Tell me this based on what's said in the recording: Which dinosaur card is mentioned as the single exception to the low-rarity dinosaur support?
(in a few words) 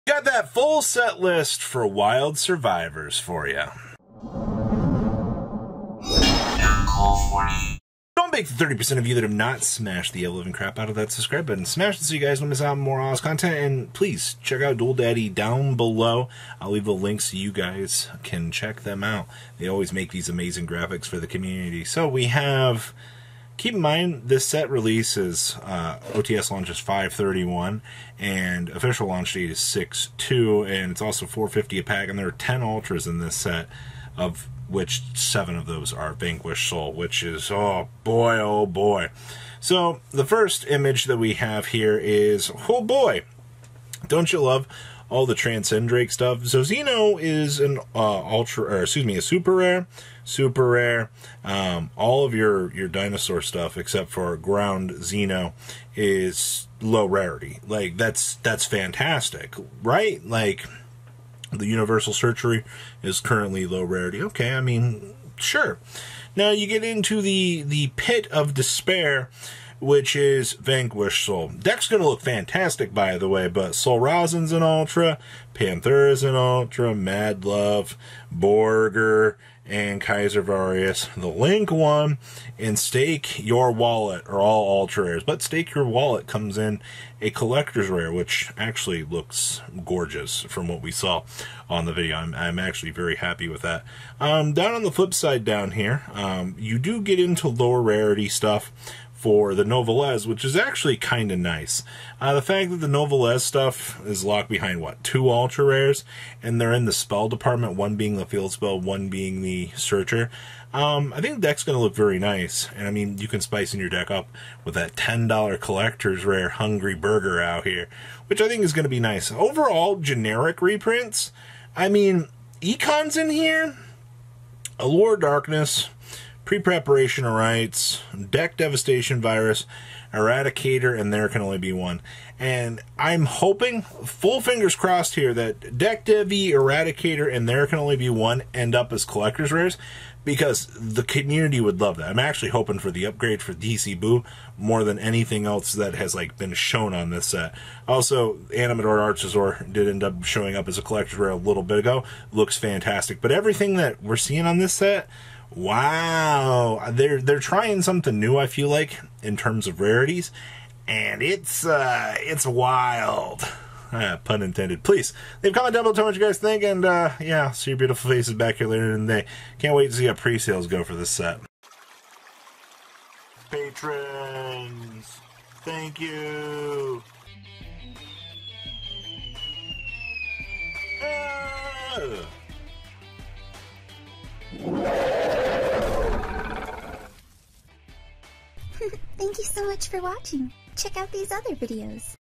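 Ground Xeno.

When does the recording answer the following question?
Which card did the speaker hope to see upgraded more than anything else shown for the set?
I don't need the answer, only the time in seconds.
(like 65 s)
143 s.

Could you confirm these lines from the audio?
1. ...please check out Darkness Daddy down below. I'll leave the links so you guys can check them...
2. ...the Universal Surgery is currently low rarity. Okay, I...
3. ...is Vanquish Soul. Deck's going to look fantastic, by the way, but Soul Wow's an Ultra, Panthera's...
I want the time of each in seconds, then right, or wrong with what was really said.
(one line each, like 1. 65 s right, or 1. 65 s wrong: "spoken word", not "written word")
1. 13 s wrong: "Duel", not "Darkness"
2. 61 s right
3. 70 s wrong: "Rosin", not "Wow".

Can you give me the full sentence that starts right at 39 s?
So the first image that we have here is, oh boy, don't you love all the Drake stuff.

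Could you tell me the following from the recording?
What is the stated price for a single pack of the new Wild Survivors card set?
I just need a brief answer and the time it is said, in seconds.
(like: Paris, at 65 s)
$4.50, at 31 s.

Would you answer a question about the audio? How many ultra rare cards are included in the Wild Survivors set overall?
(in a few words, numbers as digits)
10.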